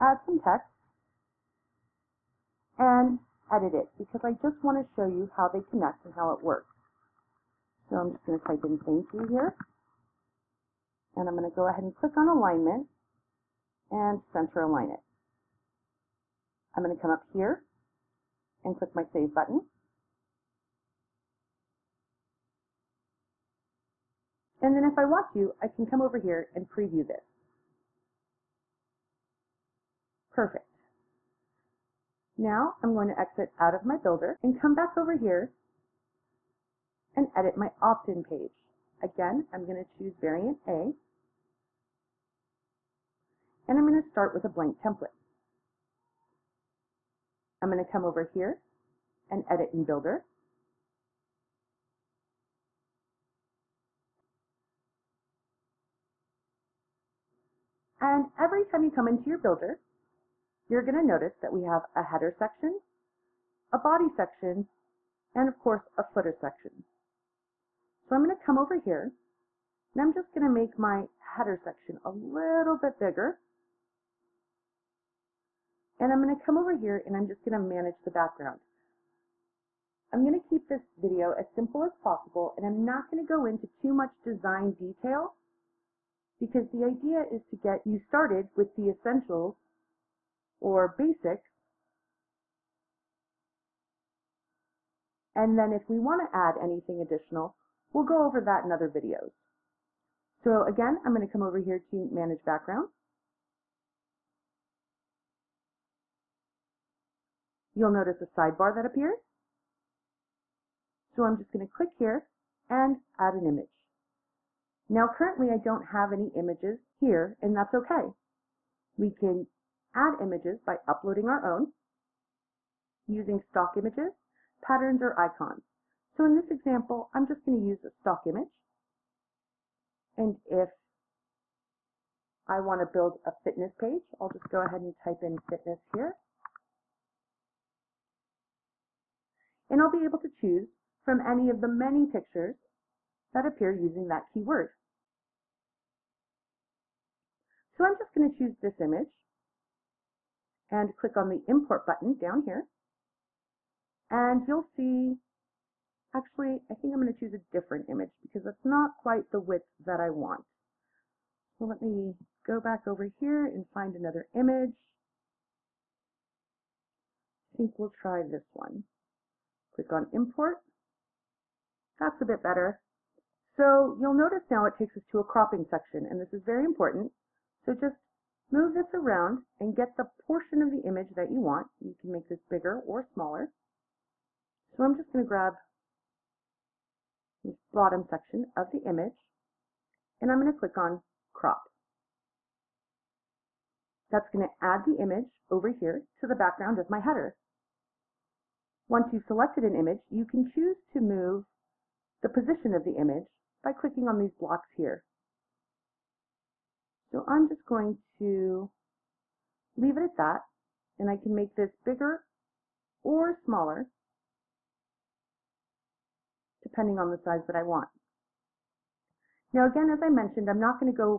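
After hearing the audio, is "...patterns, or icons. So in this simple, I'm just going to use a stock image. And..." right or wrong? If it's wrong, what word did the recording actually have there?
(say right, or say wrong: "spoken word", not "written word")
wrong: "example", not "simple".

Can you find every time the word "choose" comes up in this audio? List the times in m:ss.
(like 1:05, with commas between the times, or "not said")
0:39, 2:20, 2:28, 2:37, 3:20.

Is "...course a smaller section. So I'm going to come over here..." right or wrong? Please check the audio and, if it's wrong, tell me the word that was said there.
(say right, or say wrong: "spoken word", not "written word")
wrong: "footer", not "smaller".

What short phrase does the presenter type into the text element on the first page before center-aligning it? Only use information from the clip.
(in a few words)
thank you.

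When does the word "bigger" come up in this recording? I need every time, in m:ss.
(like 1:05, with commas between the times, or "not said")
1:12, 3:02, 3:31.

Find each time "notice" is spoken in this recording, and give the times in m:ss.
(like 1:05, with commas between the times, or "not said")
1:01, 1:47, 2:54.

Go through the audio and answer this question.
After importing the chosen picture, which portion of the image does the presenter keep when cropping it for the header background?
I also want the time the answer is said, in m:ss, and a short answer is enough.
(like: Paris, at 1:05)
bottom section, at 3:07.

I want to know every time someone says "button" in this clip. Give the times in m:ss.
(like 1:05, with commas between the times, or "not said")
0:19, 2:31.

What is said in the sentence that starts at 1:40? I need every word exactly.
So again, I'm going to come over here to Manage Background.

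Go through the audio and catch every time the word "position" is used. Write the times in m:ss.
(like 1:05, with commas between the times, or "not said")
3:22.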